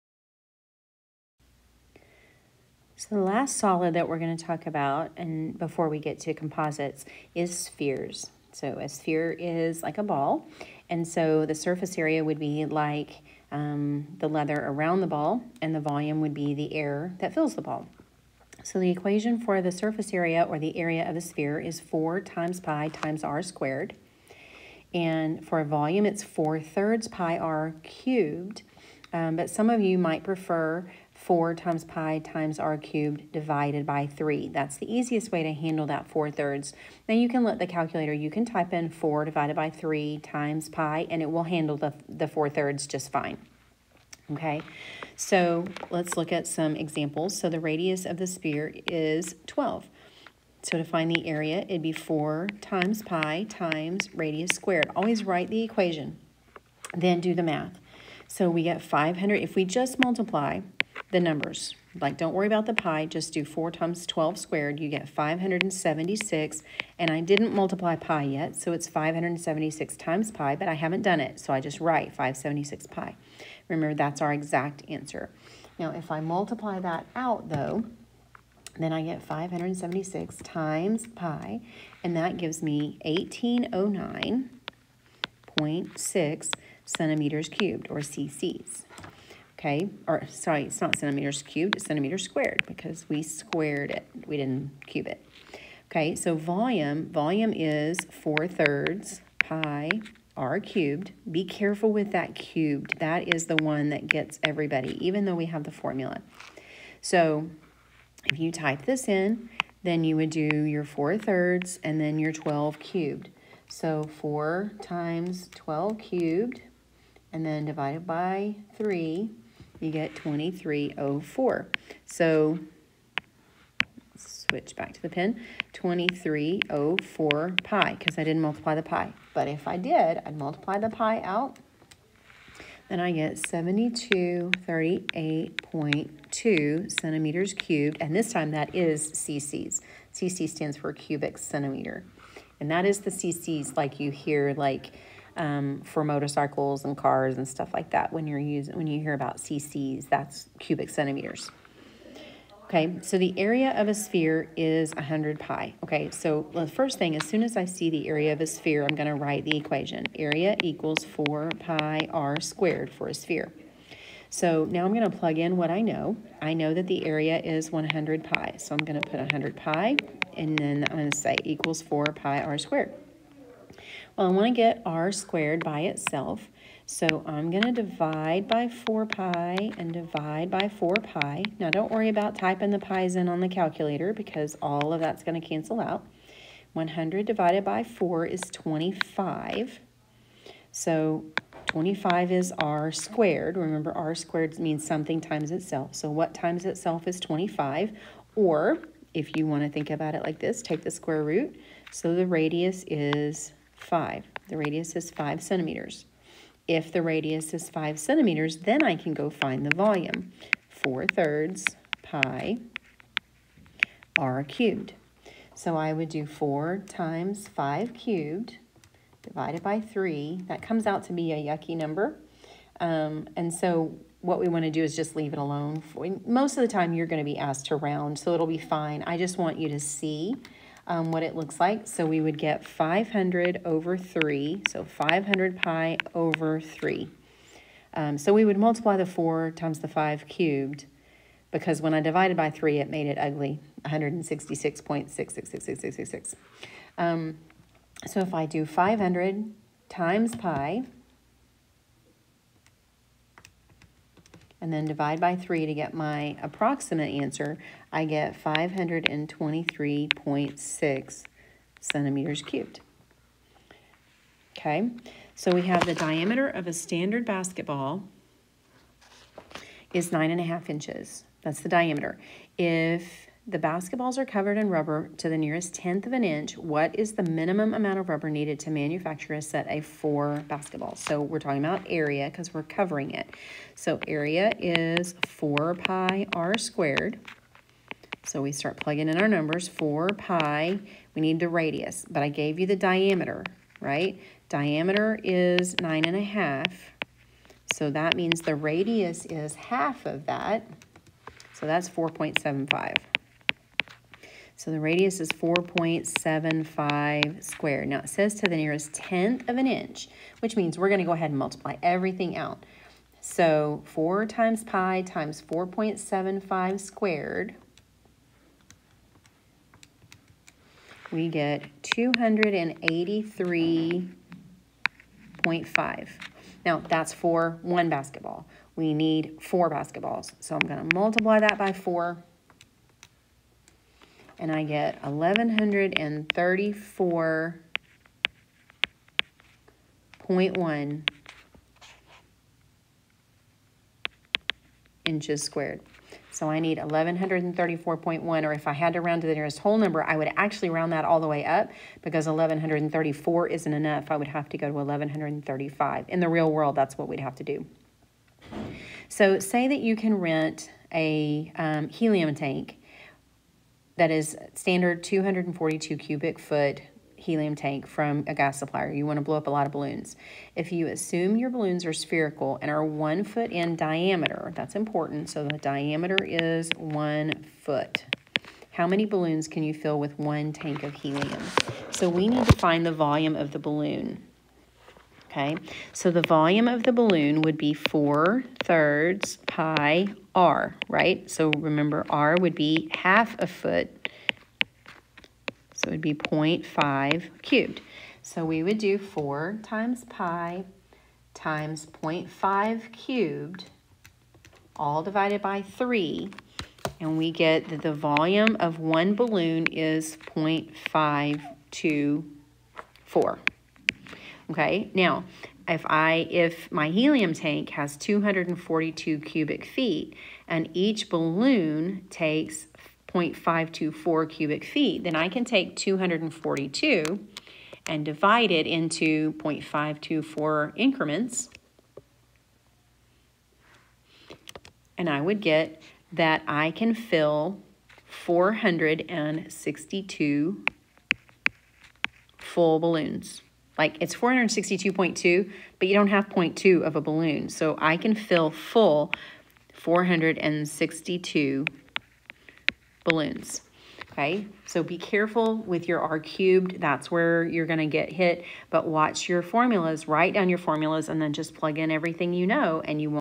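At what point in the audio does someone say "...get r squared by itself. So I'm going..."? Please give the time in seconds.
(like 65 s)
174 s.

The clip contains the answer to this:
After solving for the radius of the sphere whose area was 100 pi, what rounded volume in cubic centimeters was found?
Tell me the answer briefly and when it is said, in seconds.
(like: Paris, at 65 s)
523.6, at 258 s.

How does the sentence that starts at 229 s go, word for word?
I just want you to see um, what it looks like.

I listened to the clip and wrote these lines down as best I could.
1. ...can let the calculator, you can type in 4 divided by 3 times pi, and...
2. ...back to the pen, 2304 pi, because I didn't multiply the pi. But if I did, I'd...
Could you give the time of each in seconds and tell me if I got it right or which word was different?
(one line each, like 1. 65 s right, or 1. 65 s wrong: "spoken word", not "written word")
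1. 37 s right
2. 124 s right.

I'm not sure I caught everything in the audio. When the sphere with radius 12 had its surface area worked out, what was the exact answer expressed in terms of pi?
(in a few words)
576 pi.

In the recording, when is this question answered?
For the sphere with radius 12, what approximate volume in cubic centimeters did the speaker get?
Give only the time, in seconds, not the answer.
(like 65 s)
133 s.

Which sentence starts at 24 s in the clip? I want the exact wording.
And for volume, it's 4 thirds pi r cubed.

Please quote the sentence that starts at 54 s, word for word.
Always write the equation, then do the math.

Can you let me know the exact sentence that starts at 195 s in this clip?
So what times itself is 25?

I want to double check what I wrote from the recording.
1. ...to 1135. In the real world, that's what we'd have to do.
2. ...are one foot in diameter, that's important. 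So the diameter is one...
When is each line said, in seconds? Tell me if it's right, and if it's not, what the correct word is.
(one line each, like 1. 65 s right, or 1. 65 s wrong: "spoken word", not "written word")
1. 354 s right
2. 372 s right.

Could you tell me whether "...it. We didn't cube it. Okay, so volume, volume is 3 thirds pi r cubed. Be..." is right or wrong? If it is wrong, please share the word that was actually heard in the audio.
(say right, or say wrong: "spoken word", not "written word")
wrong: "4", not "3".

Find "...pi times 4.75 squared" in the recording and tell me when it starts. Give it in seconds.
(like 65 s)
314 s.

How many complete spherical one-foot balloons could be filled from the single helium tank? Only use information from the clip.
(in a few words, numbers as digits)
462.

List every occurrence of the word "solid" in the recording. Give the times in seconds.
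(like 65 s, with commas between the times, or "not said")
3 s.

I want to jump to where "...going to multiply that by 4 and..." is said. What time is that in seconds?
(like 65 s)
330 s.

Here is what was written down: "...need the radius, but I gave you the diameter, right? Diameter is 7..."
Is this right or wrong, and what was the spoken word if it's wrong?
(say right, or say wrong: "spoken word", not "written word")
wrong: "9", not "7".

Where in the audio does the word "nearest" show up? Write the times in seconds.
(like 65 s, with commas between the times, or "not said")
275 s, 308 s, 349 s.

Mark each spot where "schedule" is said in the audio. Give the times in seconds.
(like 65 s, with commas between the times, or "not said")
not said.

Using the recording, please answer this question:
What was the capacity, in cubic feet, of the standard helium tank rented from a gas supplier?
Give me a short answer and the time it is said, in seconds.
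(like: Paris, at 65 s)
242 cubic feet, at 365 s.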